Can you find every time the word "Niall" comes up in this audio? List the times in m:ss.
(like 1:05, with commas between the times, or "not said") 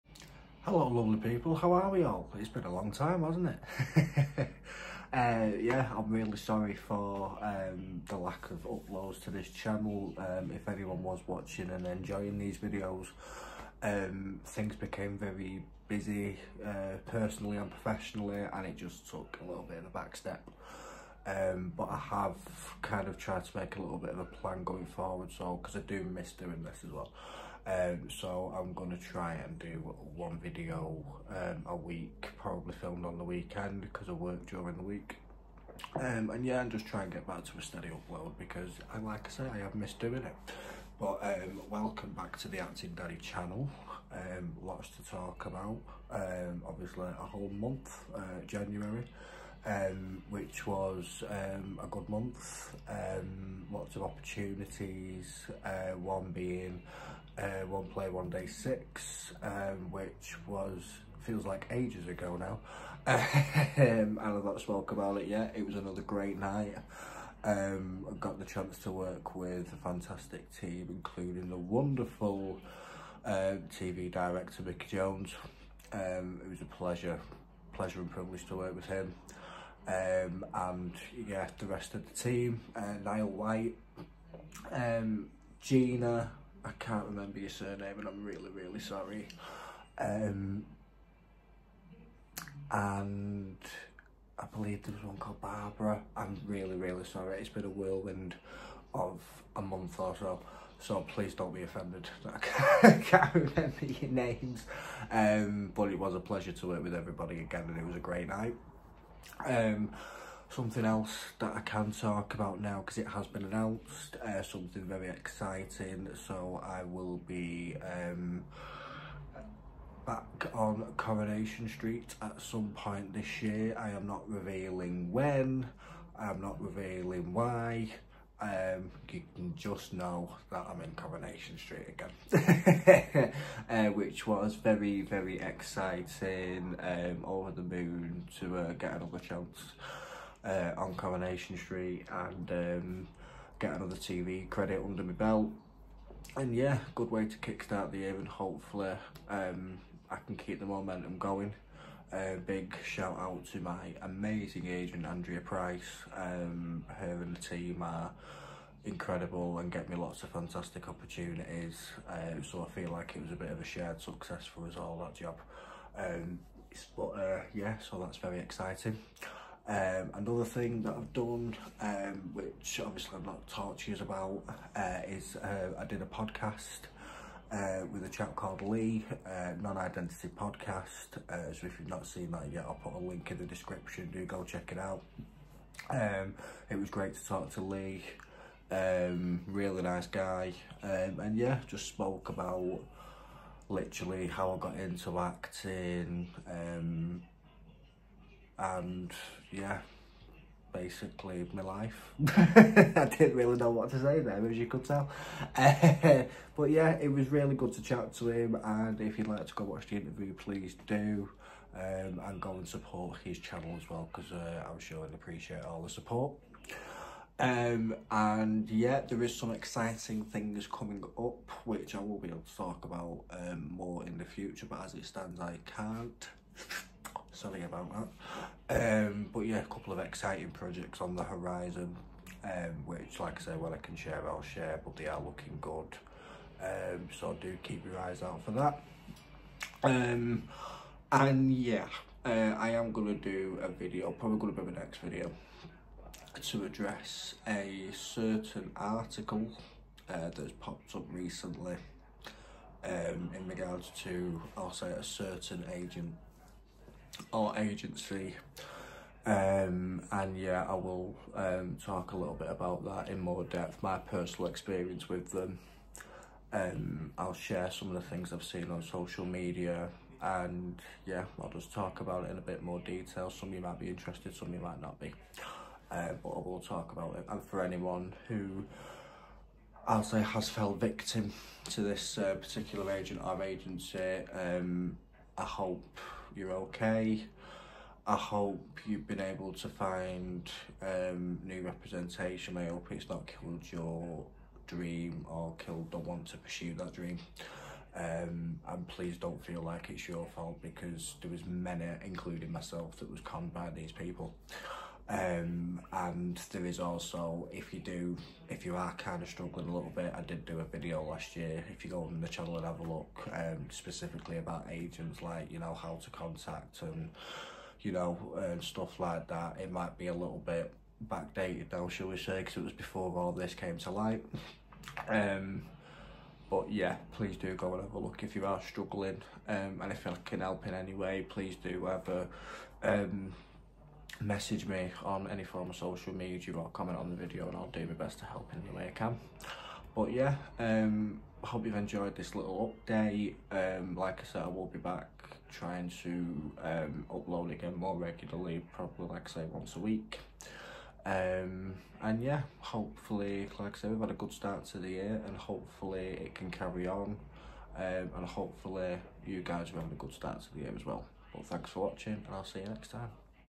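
1:23.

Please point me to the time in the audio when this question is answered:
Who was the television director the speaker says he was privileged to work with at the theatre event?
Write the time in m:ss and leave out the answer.
1:14.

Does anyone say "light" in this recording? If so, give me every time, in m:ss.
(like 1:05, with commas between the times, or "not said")
5:23.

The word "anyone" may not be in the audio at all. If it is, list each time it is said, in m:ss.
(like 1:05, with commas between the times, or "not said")
0:10, 4:37.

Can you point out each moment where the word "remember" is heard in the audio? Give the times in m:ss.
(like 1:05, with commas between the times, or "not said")
1:27, 1:43.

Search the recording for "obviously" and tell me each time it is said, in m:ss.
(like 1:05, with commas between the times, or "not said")
0:46, 2:52.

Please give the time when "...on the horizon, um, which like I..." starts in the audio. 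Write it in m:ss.
3:51.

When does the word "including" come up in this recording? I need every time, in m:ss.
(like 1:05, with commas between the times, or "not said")
1:10, 5:02.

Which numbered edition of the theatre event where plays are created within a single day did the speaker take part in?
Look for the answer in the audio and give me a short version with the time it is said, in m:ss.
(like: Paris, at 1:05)
One Play One Day 6, at 0:57.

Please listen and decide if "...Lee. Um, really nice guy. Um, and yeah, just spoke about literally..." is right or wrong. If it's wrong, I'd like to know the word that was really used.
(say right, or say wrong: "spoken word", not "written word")
right.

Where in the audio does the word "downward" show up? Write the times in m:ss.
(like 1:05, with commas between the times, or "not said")
not said.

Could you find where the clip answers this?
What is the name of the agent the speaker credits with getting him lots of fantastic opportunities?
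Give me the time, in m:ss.
2:35.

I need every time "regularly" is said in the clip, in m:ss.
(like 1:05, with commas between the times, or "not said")
5:47.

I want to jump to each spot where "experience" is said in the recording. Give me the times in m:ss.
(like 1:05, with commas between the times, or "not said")
4:24.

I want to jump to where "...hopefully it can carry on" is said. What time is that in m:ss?
5:55.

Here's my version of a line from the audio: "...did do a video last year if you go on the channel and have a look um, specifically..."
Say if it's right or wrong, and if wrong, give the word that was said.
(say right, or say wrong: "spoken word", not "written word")
right.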